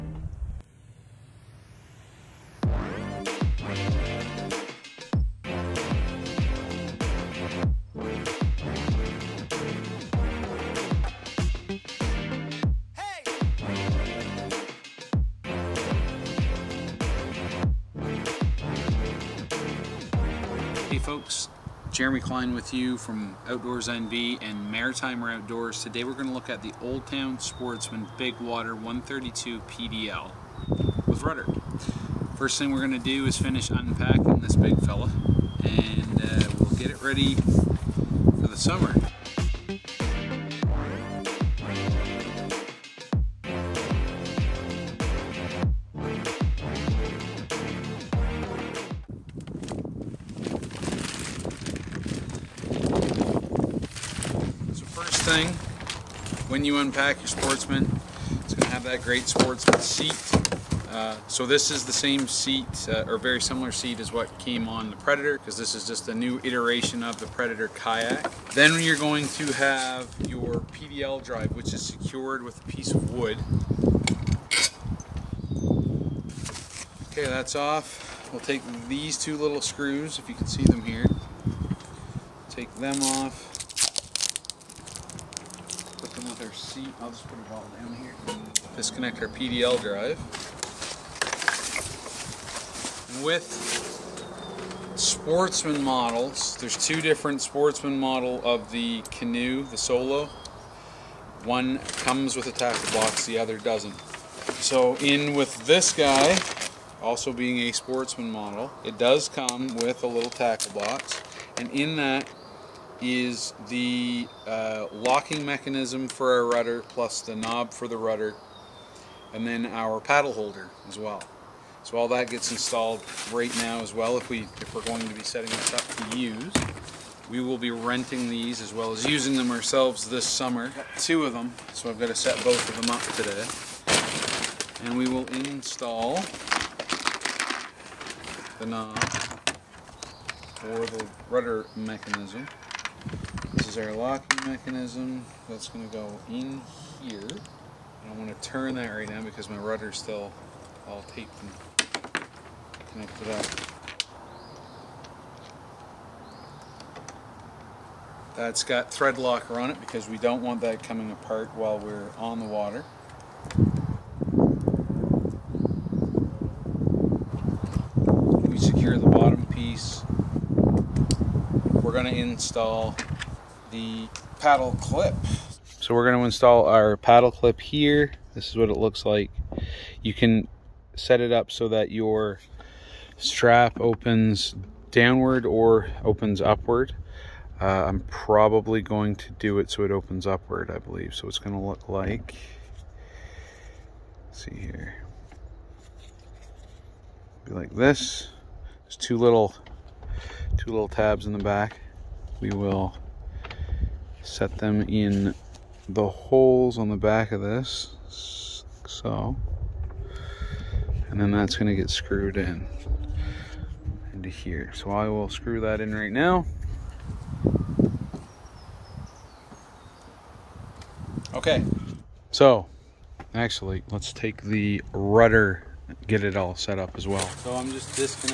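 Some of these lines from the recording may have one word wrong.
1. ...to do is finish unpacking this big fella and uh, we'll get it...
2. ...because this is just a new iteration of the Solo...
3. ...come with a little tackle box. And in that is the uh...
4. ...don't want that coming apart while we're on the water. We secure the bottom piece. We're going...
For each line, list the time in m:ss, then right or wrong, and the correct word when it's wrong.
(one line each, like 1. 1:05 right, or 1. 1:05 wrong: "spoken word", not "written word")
1. 0:32 right
2. 1:05 wrong: "Predator", not "Solo"
3. 1:49 right
4. 2:40 right.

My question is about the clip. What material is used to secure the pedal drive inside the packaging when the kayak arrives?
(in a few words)
A piece of wood.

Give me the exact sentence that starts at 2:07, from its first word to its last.
We will be renting these as well as using them ourselves this summer.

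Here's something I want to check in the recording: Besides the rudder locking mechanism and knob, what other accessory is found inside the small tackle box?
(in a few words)
Paddle holder.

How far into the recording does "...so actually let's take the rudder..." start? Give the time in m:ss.
3:42.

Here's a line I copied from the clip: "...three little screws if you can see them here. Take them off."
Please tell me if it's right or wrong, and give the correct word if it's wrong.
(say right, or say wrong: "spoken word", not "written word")
wrong: "two", not "three".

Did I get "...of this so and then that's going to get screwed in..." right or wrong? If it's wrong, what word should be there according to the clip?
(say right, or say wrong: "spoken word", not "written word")
right.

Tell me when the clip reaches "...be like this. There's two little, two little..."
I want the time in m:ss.
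3:17.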